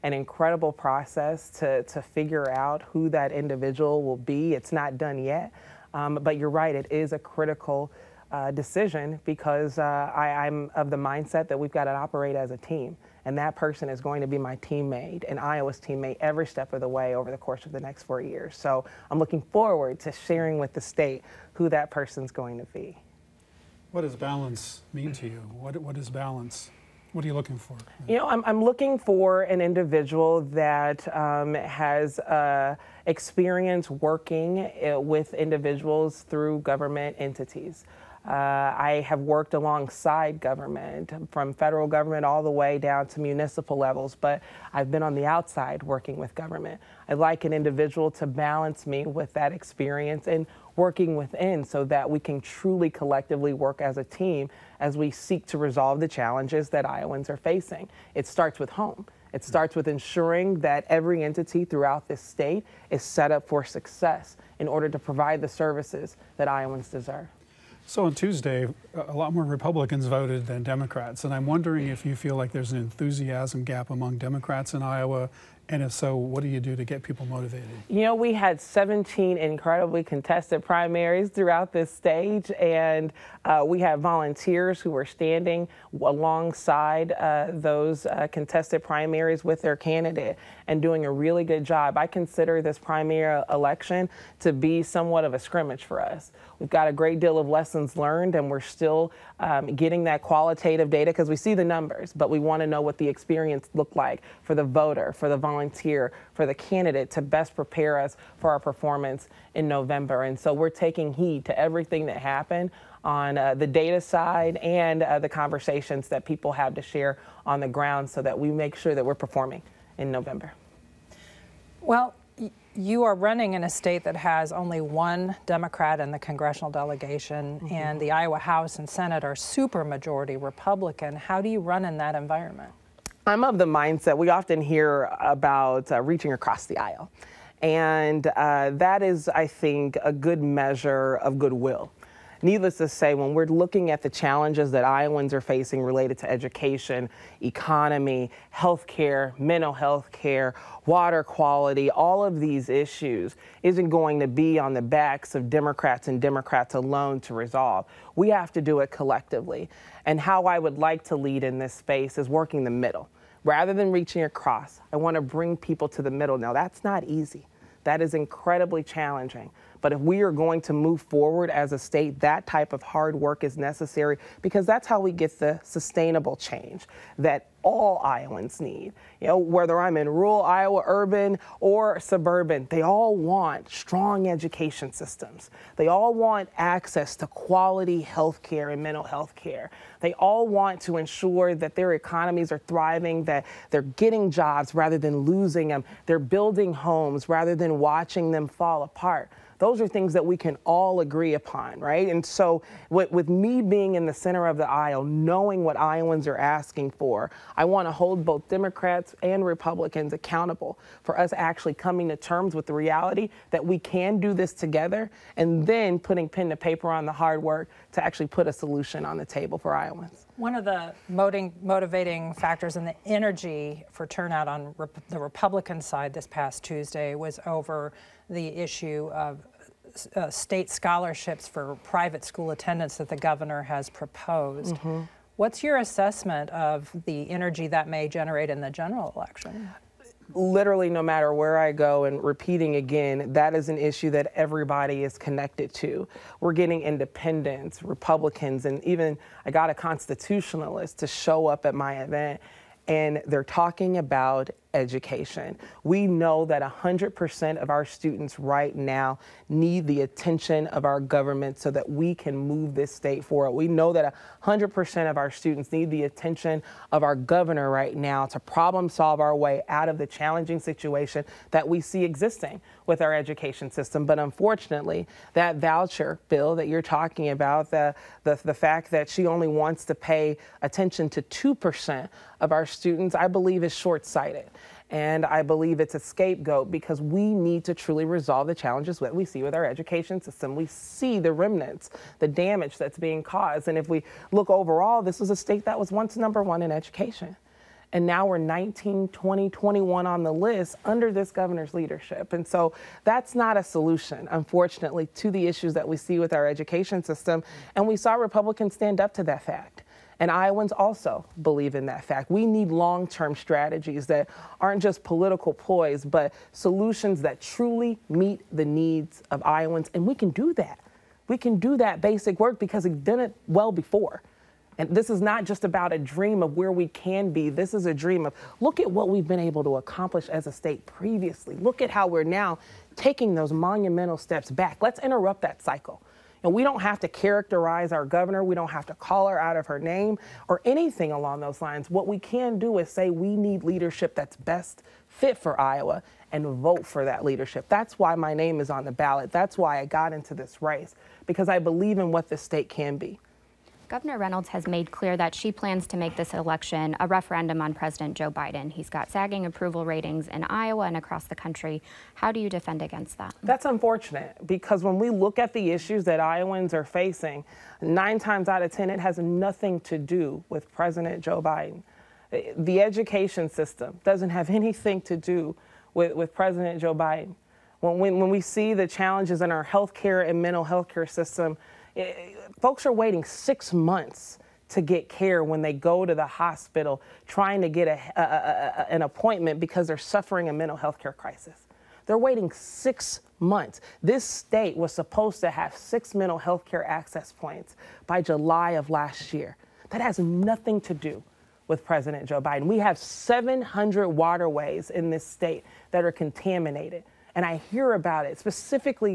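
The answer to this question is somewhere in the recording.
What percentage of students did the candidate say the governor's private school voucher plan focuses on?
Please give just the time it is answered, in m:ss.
4:41.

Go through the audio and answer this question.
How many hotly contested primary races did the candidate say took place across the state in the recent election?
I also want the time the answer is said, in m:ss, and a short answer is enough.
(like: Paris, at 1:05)
17, at 1:18.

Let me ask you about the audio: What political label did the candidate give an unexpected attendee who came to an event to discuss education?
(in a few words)
constitutionalist.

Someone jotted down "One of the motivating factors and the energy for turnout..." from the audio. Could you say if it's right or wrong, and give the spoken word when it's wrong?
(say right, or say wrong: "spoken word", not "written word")
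right.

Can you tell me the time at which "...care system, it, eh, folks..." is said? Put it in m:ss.
6:20.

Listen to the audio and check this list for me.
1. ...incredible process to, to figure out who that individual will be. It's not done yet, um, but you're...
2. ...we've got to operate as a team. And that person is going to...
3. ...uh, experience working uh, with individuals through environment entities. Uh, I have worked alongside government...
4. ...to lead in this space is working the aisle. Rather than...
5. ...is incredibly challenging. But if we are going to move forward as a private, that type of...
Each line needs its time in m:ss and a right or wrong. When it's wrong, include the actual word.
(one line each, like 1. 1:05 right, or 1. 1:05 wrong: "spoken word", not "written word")
1. 0:00 right
2. 0:11 right
3. 0:32 wrong: "government", not "environment"
4. 2:41 wrong: "middle", not "aisle"
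5. 2:48 wrong: "state", not "private".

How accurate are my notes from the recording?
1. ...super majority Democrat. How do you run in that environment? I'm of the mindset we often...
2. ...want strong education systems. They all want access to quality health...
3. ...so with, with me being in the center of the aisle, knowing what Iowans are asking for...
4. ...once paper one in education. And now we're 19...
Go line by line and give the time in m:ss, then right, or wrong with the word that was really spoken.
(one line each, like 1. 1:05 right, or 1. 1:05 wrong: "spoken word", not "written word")
1. 2:09 wrong: "Republican", not "Democrat"
2. 3:03 right
3. 3:22 right
4. 4:55 wrong: "number", not "paper".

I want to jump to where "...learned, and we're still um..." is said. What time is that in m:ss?
1:37.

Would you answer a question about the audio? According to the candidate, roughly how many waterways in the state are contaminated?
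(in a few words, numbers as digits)
700.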